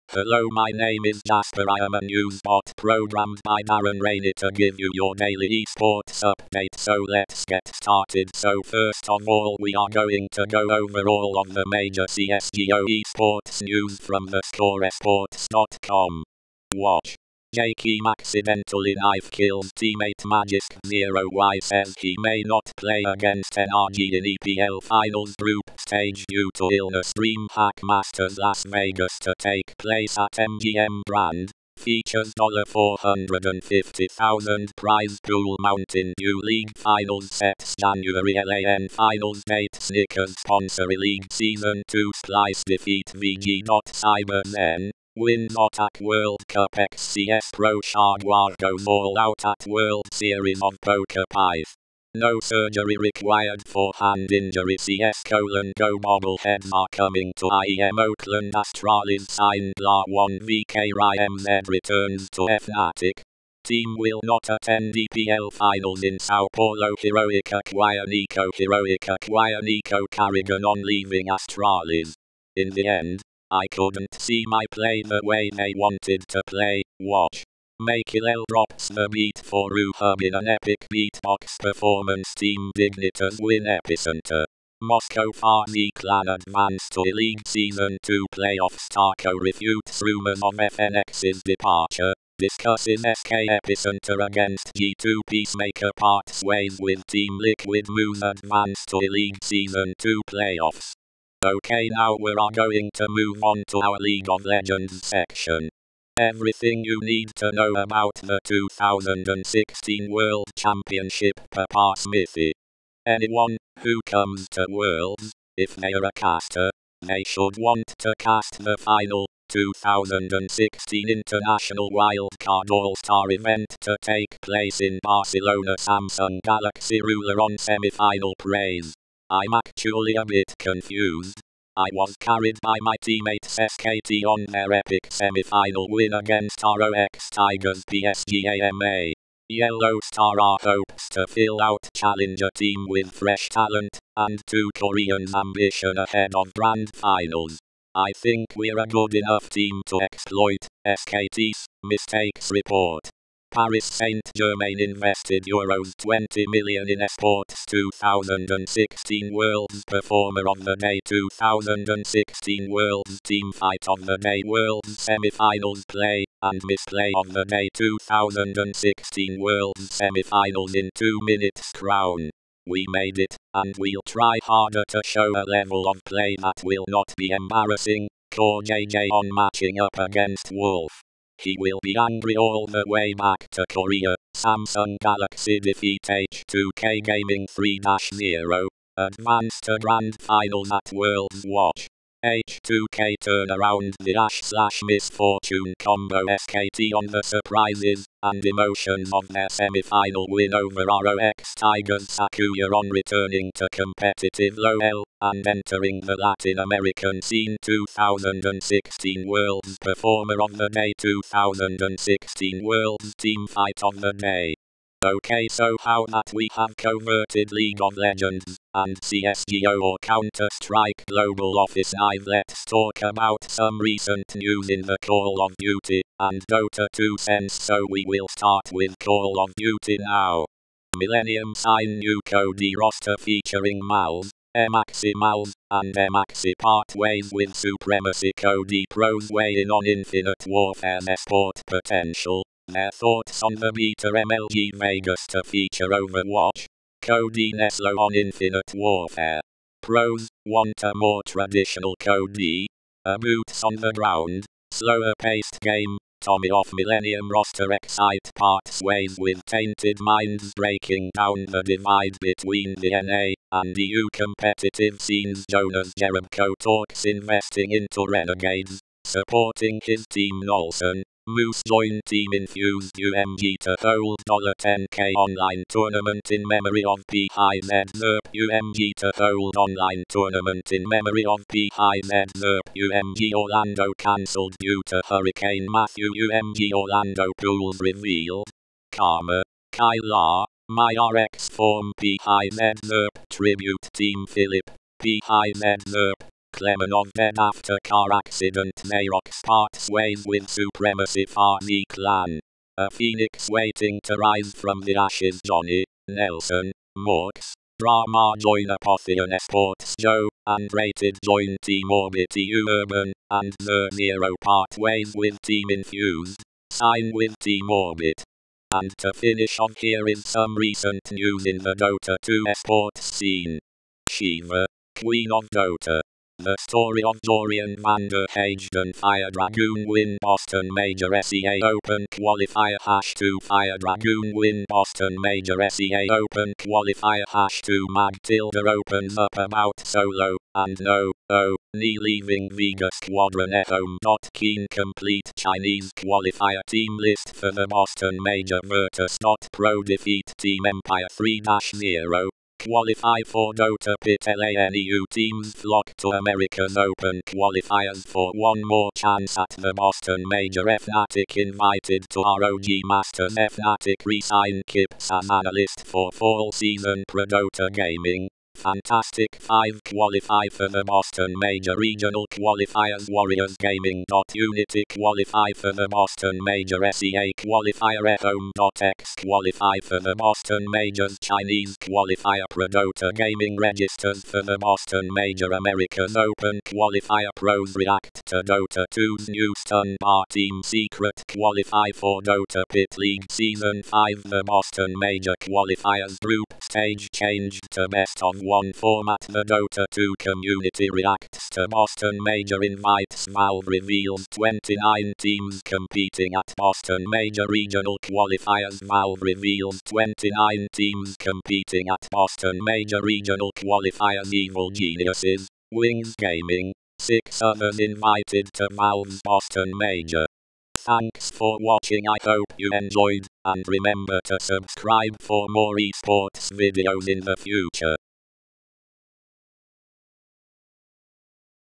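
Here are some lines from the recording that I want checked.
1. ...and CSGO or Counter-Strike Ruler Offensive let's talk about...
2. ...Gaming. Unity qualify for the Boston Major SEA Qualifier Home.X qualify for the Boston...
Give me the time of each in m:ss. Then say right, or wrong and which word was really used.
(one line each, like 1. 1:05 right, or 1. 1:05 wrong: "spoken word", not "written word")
1. 3:38 wrong: "Global", not "Ruler"
2. 6:13 right.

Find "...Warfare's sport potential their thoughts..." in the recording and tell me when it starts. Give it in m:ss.
4:00.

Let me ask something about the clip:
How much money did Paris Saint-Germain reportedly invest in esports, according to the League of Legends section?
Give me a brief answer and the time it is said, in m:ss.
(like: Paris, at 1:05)
20 million euros, at 2:35.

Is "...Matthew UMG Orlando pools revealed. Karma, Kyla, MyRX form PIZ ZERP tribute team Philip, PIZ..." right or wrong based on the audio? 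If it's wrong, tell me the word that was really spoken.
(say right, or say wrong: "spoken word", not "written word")
right.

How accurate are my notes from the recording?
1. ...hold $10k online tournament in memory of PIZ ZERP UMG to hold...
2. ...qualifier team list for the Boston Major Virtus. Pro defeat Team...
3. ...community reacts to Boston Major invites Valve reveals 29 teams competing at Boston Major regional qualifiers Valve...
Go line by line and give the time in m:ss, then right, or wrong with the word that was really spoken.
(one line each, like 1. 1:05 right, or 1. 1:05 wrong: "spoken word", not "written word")
1. 4:33 right
2. 5:45 right
3. 6:40 right.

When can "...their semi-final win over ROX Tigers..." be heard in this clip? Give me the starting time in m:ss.
3:19.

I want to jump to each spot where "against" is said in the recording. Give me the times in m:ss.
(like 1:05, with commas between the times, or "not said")
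0:23, 1:34, 2:16, 2:59.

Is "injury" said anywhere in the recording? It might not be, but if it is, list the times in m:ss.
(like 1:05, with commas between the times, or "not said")
0:54.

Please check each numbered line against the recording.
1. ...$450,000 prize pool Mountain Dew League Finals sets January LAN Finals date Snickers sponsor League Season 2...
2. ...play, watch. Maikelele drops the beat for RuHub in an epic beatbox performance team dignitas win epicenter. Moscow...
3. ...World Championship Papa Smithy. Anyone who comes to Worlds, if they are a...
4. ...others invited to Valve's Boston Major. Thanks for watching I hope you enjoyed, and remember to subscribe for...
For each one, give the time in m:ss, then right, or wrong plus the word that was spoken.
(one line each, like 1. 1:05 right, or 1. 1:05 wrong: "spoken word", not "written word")
1. 0:32 right
2. 1:16 right
3. 1:50 right
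4. 6:57 right.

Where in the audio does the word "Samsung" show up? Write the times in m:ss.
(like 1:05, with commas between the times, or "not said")
2:05, 3:04.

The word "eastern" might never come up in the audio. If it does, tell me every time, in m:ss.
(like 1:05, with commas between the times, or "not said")
not said.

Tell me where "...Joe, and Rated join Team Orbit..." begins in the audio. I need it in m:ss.
5:09.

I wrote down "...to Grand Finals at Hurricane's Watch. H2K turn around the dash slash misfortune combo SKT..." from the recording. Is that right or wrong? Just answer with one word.
wrong.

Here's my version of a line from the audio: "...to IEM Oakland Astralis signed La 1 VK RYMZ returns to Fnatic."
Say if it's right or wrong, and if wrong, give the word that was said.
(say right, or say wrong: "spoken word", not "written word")
right.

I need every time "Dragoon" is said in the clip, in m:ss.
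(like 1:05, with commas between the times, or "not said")
5:29, 5:33.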